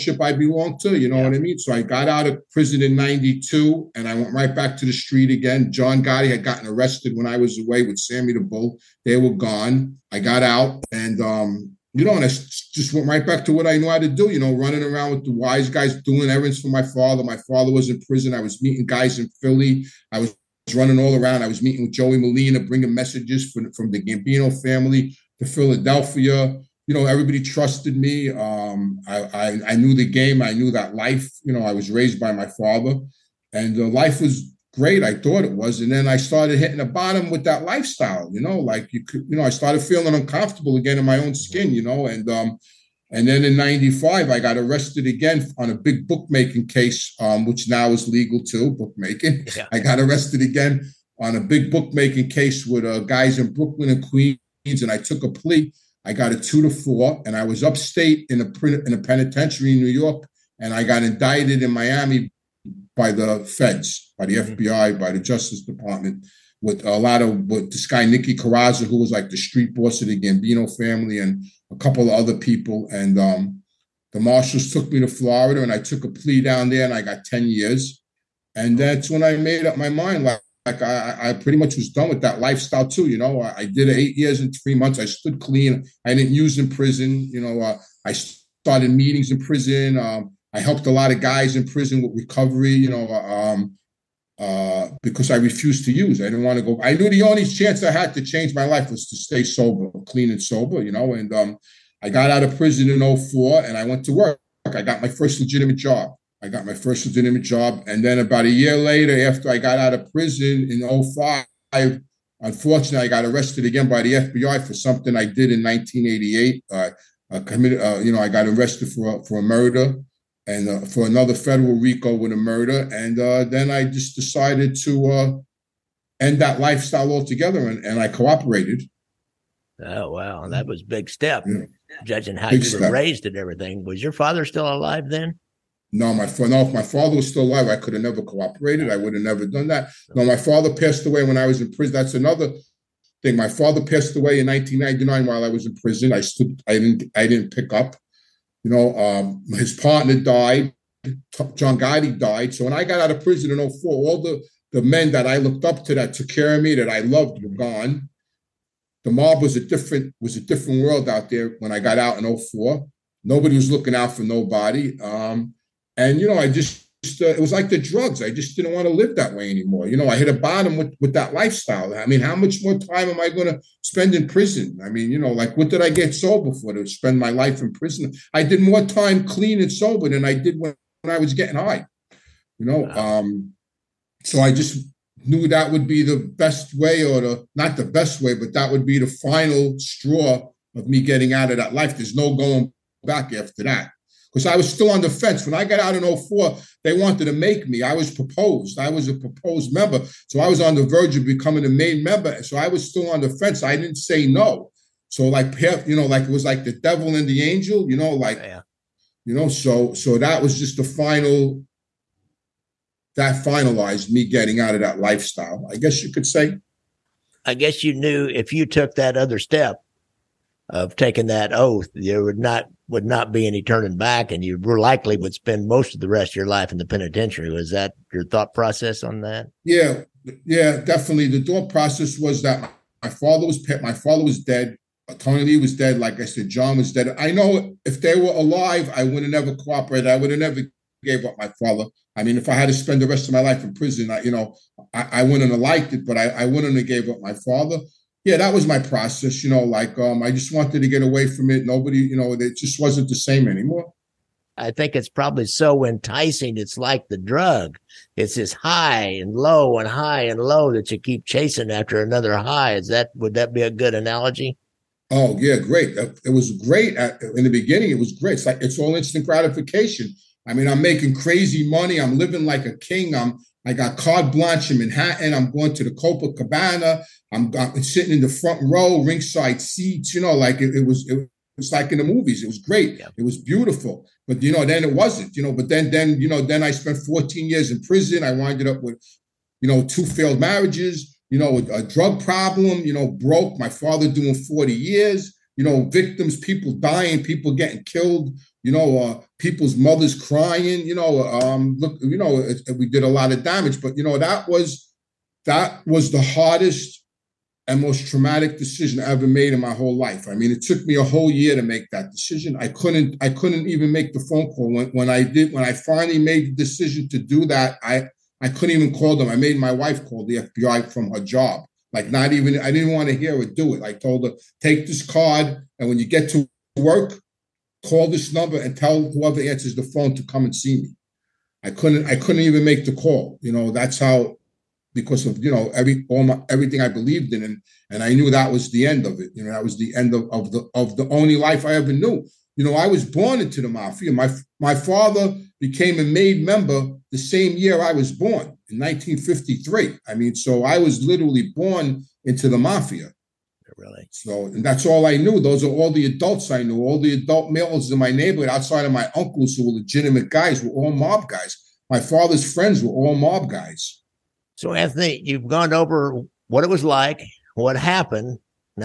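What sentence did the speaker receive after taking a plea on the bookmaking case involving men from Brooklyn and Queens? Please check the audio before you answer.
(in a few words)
2 to 4.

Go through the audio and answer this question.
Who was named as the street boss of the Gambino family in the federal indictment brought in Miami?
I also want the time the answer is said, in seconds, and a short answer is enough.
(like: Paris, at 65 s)
Nicky Corozzo, at 68 s.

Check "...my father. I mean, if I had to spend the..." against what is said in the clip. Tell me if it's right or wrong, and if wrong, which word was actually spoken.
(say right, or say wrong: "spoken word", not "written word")
right.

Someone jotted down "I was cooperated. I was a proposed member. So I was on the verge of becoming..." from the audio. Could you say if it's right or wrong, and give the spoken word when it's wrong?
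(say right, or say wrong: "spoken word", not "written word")
wrong: "proposed", not "cooperated".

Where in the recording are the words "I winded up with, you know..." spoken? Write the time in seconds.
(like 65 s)
288 s.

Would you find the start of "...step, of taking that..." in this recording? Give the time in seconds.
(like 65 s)
219 s.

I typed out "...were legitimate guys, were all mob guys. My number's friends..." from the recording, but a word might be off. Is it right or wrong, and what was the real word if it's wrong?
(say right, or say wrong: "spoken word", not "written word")
wrong: "father", not "number".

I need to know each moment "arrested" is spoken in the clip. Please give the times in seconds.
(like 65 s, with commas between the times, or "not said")
6 s, 44 s, 49 s, 113 s, 118 s.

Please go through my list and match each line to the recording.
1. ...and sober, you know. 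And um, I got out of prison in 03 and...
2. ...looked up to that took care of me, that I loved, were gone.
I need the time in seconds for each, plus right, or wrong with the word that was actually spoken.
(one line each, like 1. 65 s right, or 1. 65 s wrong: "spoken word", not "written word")
1. 100 s wrong: "04", not "03"
2. 155 s right.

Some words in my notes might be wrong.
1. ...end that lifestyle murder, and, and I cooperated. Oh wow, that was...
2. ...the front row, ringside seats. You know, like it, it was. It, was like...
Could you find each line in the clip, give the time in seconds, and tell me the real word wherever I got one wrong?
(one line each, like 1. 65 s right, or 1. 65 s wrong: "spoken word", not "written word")
1. 126 s wrong: "altogether", not "murder"
2. 278 s right.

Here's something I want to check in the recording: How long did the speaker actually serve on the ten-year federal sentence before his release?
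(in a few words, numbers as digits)
8 years and 3 months.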